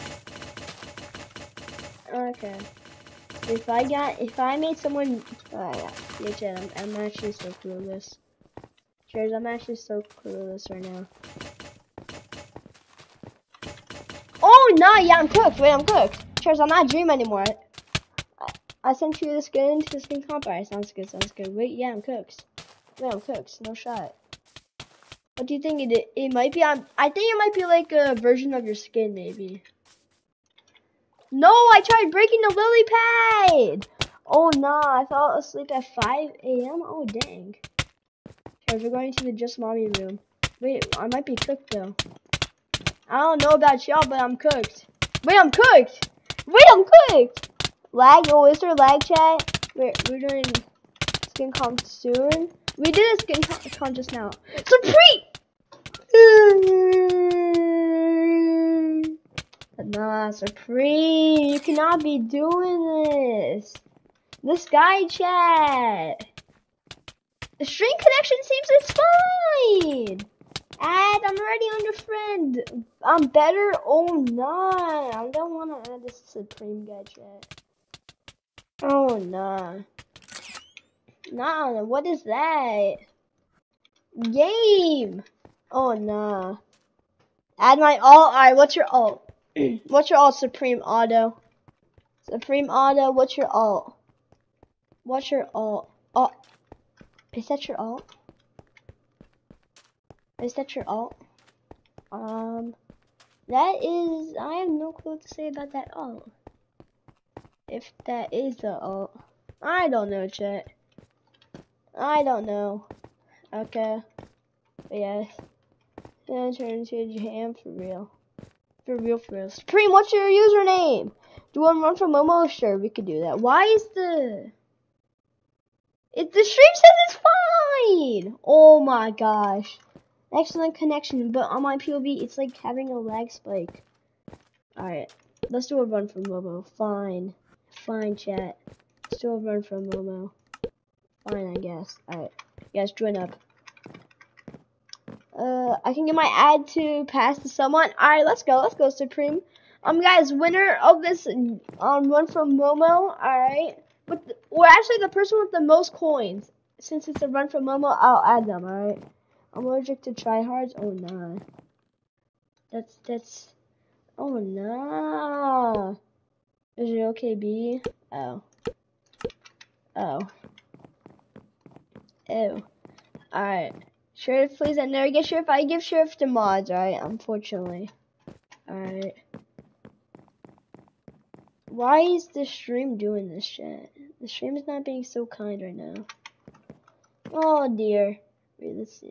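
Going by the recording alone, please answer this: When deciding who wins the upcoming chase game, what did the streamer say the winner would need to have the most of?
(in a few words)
coins.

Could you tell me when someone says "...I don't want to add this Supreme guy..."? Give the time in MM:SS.
01:15.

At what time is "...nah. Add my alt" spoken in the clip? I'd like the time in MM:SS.
01:25.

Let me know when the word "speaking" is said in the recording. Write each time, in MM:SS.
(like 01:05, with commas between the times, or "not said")
not said.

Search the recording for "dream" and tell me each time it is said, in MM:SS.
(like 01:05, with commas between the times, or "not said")
00:16.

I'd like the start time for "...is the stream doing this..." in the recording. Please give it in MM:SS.
03:02.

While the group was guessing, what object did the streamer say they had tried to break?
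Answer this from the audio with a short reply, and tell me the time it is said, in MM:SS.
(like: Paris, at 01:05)
lily pad, at 00:32.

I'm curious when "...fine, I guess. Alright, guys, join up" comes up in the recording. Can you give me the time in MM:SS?
02:21.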